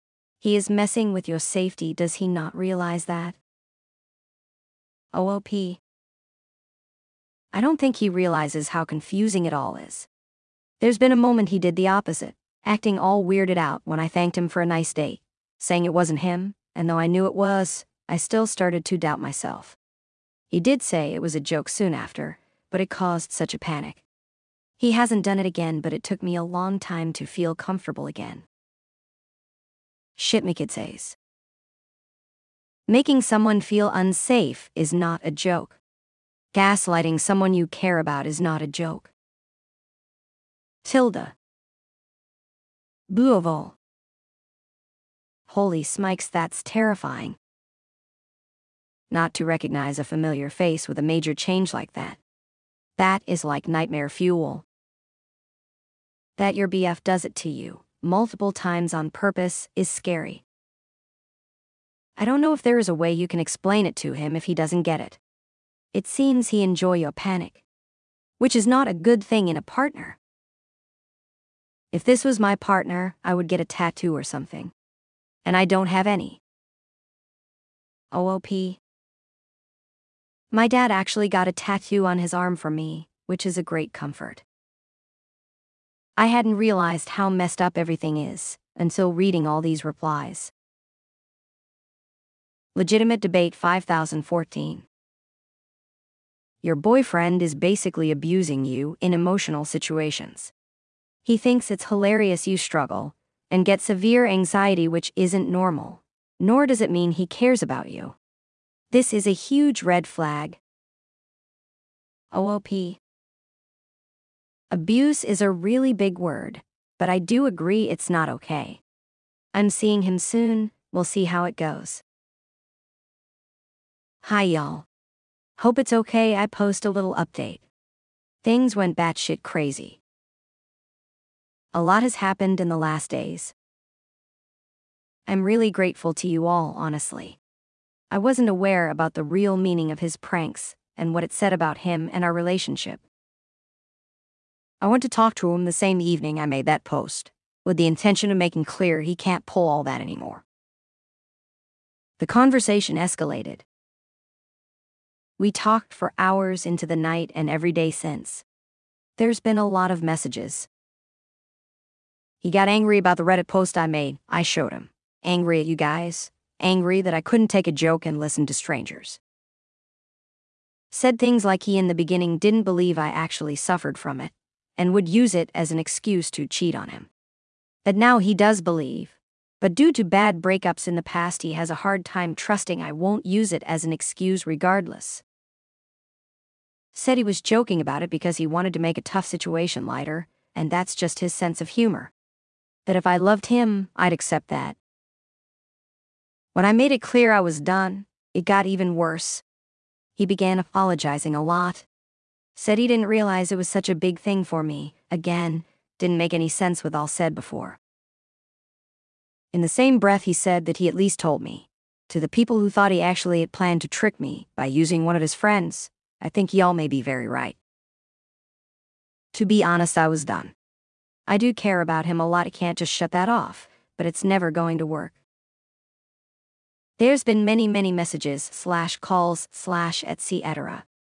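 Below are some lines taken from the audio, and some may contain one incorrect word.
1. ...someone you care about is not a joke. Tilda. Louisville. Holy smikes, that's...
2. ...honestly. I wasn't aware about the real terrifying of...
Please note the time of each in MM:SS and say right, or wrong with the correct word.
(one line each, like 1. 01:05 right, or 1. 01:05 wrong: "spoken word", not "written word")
1. 00:37 right
2. 02:16 wrong: "meaning", not "terrifying".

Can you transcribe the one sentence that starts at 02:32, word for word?
The conversation escalated, we talked for hours into the night and every day since.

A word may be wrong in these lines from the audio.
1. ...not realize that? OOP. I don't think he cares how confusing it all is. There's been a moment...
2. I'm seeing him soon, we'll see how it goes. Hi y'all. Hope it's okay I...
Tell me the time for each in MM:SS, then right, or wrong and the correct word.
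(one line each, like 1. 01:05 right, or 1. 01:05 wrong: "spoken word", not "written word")
1. 00:02 wrong: "realizes", not "cares"
2. 01:59 right.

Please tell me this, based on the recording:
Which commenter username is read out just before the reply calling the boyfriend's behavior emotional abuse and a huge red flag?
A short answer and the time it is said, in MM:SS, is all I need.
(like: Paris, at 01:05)
LegitimateDebate5014, at 01:32.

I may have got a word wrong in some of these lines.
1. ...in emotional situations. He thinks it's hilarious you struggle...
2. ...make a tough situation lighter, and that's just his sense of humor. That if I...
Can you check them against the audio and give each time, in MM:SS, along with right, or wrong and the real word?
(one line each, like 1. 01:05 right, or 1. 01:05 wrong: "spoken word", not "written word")
1. 01:38 right
2. 03:08 right.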